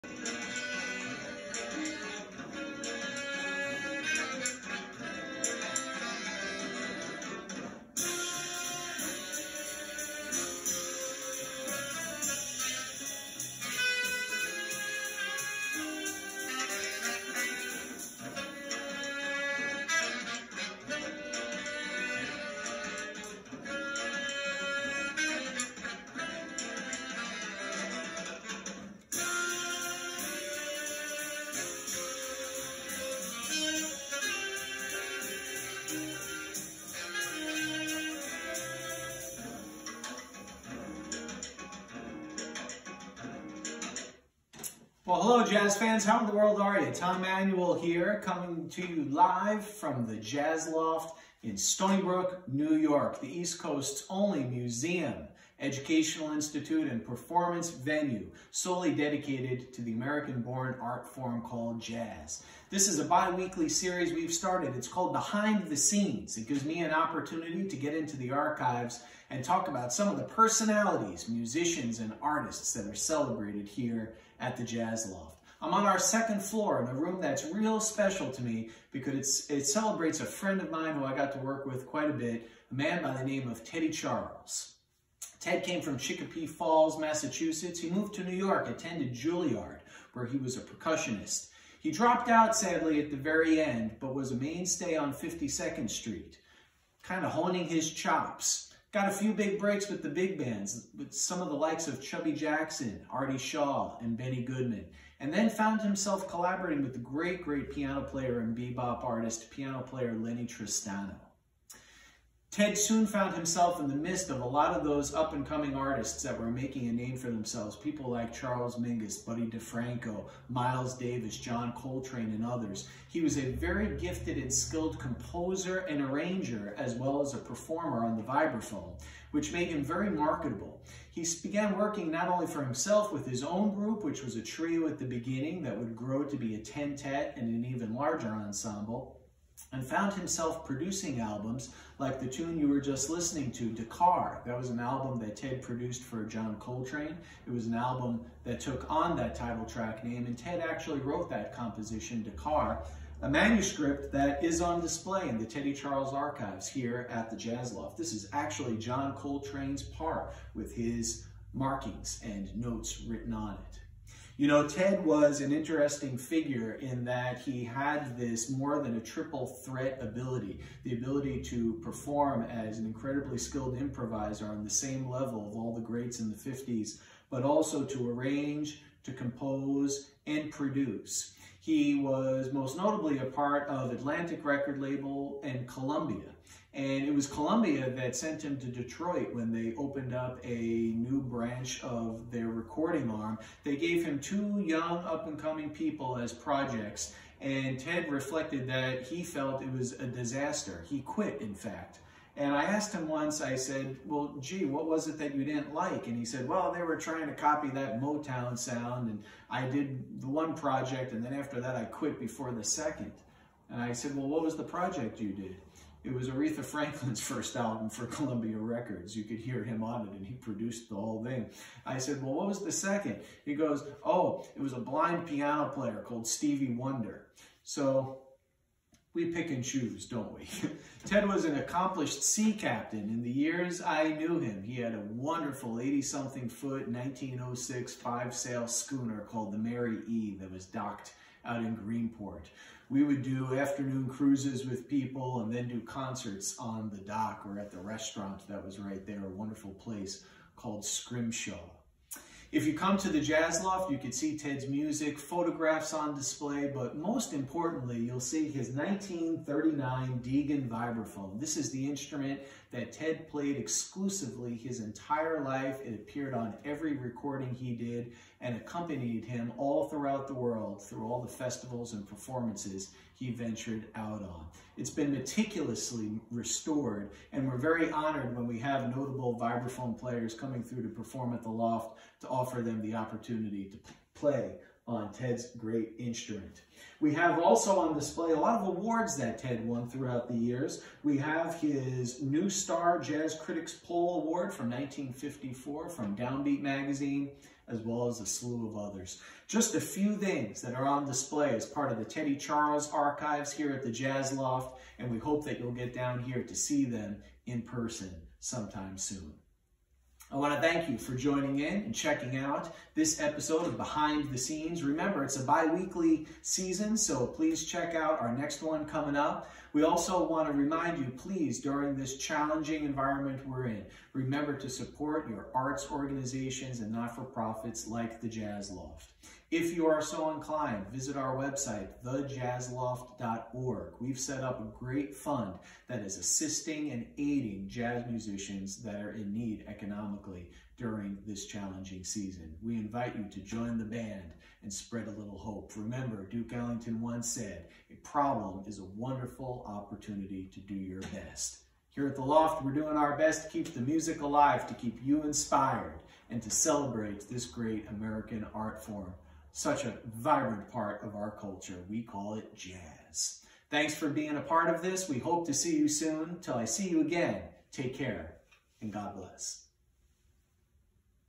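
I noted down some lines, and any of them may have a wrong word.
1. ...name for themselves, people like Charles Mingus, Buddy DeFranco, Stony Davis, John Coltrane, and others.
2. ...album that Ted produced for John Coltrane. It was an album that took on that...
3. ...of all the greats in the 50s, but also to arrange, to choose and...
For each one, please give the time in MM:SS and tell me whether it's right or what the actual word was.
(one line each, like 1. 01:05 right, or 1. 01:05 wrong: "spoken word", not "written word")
1. 01:56 wrong: "Miles", not "Stony"
2. 02:24 right
3. 02:55 wrong: "compose", not "choose".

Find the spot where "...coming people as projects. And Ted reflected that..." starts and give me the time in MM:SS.
03:15.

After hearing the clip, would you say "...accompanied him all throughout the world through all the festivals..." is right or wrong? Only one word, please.
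right.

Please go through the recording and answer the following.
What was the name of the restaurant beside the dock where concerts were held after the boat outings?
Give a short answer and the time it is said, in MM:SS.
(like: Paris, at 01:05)
Scrimshaw, at 04:10.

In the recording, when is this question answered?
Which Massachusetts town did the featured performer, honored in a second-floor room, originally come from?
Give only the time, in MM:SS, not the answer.
01:25.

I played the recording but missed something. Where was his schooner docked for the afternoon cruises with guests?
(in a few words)
Greenport.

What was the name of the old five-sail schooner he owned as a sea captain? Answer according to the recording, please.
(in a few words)
Mary E.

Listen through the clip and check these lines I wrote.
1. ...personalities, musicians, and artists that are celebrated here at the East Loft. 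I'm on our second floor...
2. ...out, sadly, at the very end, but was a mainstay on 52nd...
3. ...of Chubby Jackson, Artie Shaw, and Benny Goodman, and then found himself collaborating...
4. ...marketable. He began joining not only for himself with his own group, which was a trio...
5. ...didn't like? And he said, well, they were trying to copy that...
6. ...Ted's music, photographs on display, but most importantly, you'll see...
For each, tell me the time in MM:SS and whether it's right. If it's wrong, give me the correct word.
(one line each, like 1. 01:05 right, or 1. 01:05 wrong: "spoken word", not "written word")
1. 01:10 wrong: "Jazz", not "East"
2. 01:32 right
3. 01:41 right
4. 02:10 wrong: "working", not "joining"
5. 03:25 right
6. 04:14 right.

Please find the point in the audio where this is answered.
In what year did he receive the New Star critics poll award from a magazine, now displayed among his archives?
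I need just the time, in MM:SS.
04:54.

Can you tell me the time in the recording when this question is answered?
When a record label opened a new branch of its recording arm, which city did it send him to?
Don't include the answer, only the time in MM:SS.
03:08.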